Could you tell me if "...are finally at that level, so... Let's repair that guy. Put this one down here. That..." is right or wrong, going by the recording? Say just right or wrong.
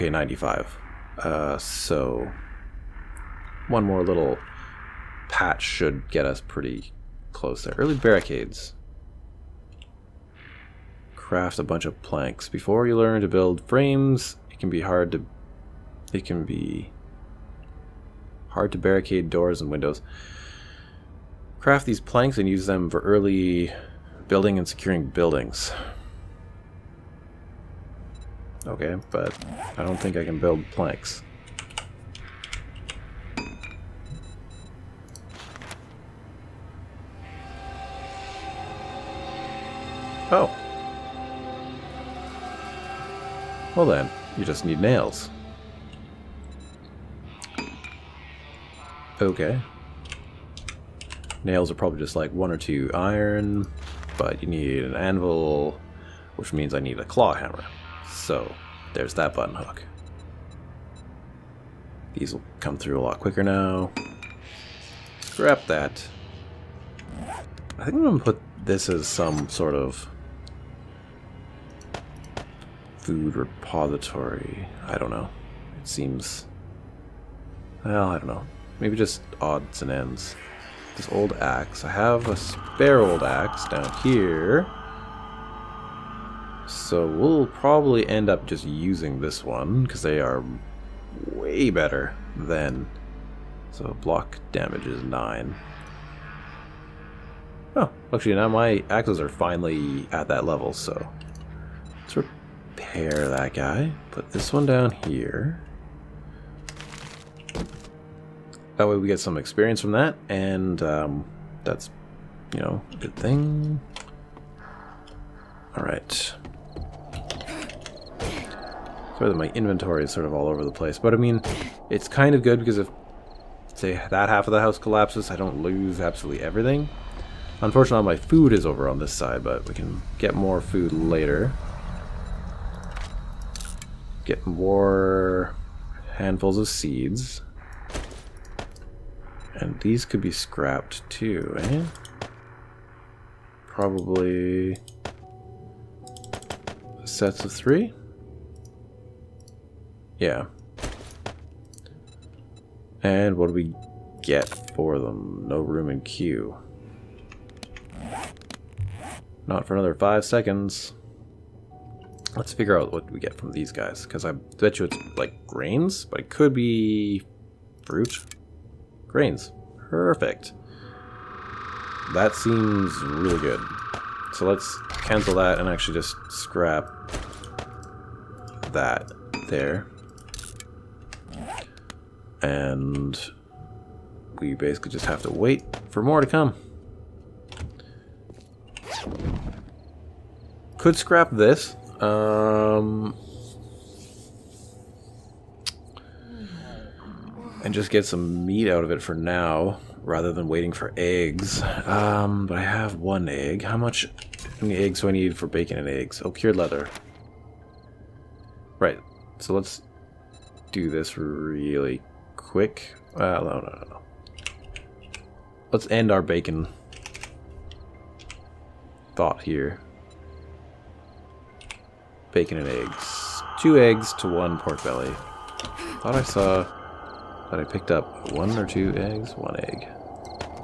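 right.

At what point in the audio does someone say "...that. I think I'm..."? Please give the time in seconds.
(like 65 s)
65 s.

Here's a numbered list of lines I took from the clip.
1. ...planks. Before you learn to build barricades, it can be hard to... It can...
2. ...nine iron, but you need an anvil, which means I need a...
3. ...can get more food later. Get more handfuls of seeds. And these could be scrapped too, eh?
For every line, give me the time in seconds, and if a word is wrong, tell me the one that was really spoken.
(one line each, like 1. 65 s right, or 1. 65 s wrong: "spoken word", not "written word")
1. 12 s wrong: "frames", not "barricades"
2. 52 s wrong: "two", not "nine"
3. 129 s right.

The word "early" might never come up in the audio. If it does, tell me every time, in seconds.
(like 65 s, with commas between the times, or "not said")
7 s, 23 s.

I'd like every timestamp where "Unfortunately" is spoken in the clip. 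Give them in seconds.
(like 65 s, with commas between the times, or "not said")
127 s.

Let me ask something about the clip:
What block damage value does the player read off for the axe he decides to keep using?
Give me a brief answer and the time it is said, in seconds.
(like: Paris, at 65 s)
9, at 95 s.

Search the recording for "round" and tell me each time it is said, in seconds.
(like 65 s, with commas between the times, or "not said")
not said.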